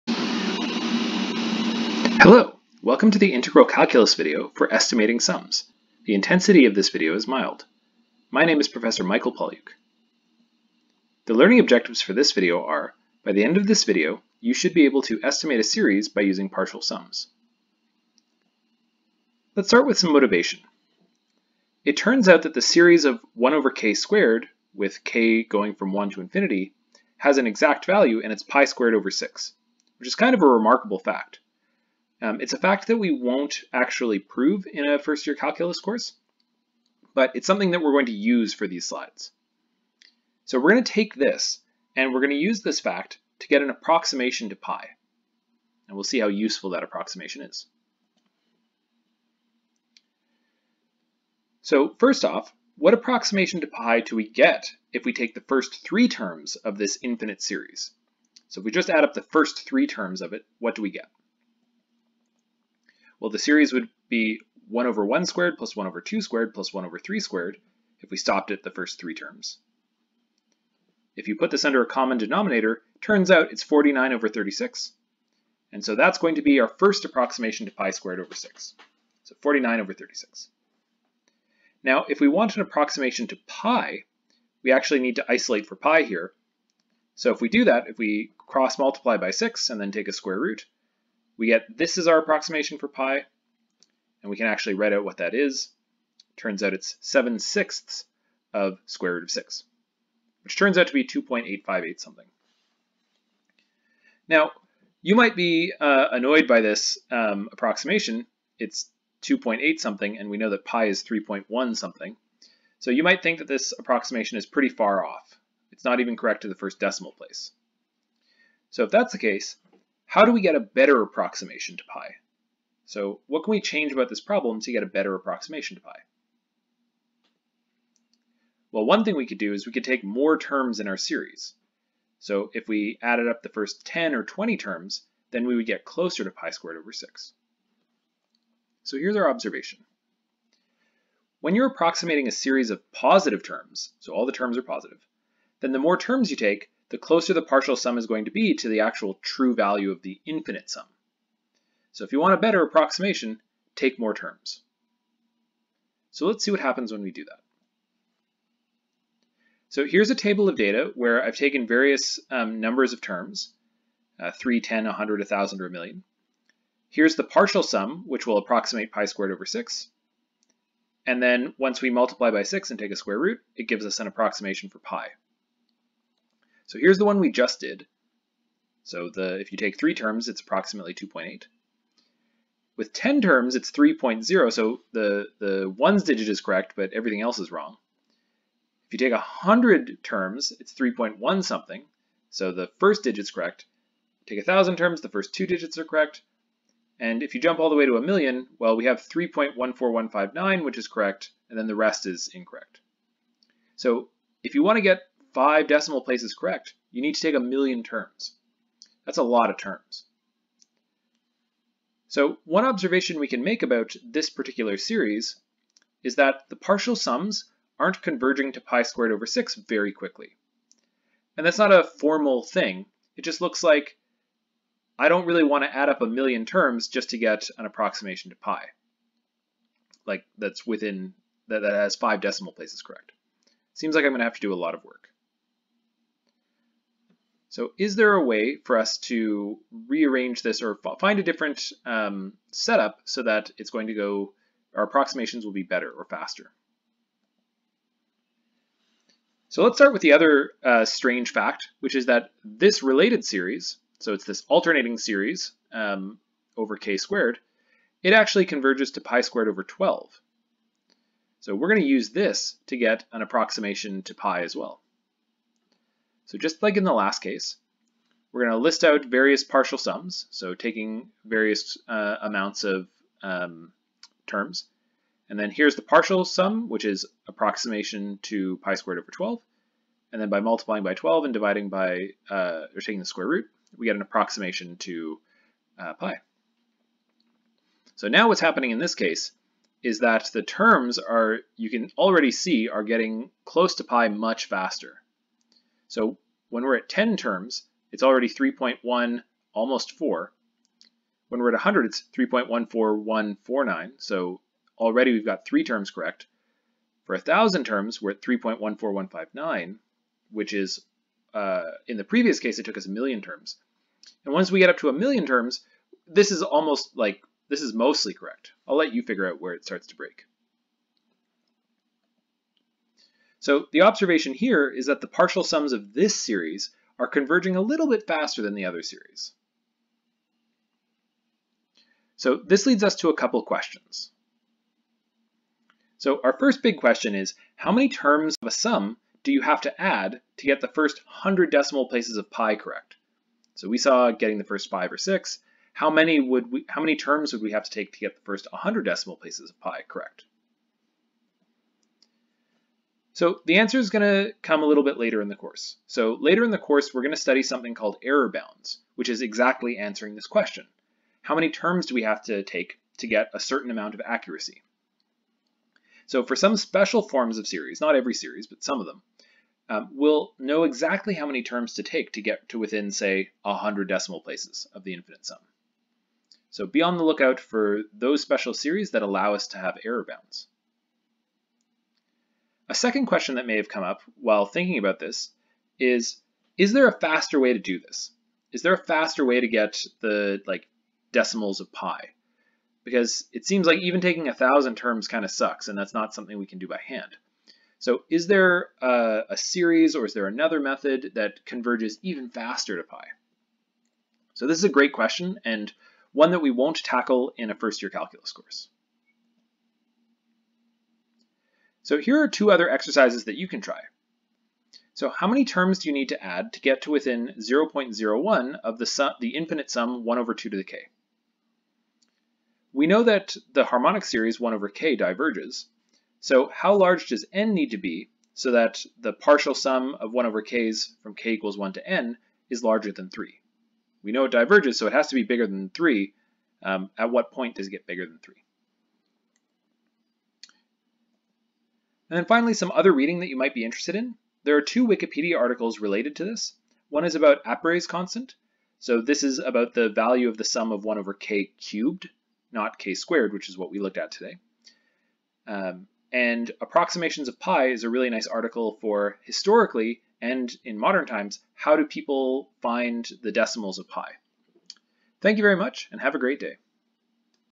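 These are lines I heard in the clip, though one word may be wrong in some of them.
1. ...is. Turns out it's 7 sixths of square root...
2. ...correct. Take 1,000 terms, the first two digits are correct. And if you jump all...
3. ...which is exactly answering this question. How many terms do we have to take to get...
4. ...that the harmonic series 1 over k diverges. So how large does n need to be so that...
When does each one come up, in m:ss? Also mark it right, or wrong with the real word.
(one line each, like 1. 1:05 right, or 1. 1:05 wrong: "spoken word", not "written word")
1. 1:35 right
2. 3:13 right
3. 5:58 right
4. 7:03 right.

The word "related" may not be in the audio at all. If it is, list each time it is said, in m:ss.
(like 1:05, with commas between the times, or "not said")
4:12, 7:25.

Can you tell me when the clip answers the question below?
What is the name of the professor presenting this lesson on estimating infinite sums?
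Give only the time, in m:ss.
0:09.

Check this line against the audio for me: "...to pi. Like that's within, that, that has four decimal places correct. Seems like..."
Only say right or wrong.
wrong.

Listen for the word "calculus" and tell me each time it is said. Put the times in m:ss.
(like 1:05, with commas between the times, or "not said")
0:03, 0:35, 6:47.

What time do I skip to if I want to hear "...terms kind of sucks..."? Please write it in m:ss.
6:34.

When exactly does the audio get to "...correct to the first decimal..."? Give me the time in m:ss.
1:56.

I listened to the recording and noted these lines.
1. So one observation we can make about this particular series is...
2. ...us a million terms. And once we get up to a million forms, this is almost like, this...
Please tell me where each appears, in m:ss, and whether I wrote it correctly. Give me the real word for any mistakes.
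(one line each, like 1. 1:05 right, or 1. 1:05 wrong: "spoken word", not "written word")
1. 3:32 right
2. 5:12 wrong: "terms", not "forms".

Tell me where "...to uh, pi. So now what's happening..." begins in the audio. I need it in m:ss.
4:44.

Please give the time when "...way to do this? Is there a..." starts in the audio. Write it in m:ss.
6:27.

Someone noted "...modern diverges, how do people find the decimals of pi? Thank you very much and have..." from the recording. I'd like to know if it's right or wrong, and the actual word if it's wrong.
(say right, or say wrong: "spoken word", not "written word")
wrong: "times", not "diverges".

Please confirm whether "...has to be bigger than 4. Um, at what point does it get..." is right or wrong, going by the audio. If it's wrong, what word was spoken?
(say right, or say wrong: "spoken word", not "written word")
wrong: "3", not "4".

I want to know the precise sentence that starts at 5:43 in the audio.
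So we saw getting the first five or six.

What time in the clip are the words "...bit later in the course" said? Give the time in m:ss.
5:54.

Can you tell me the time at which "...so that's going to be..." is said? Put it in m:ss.
1:15.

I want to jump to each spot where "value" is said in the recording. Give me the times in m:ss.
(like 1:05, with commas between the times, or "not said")
0:27, 2:29, 7:29.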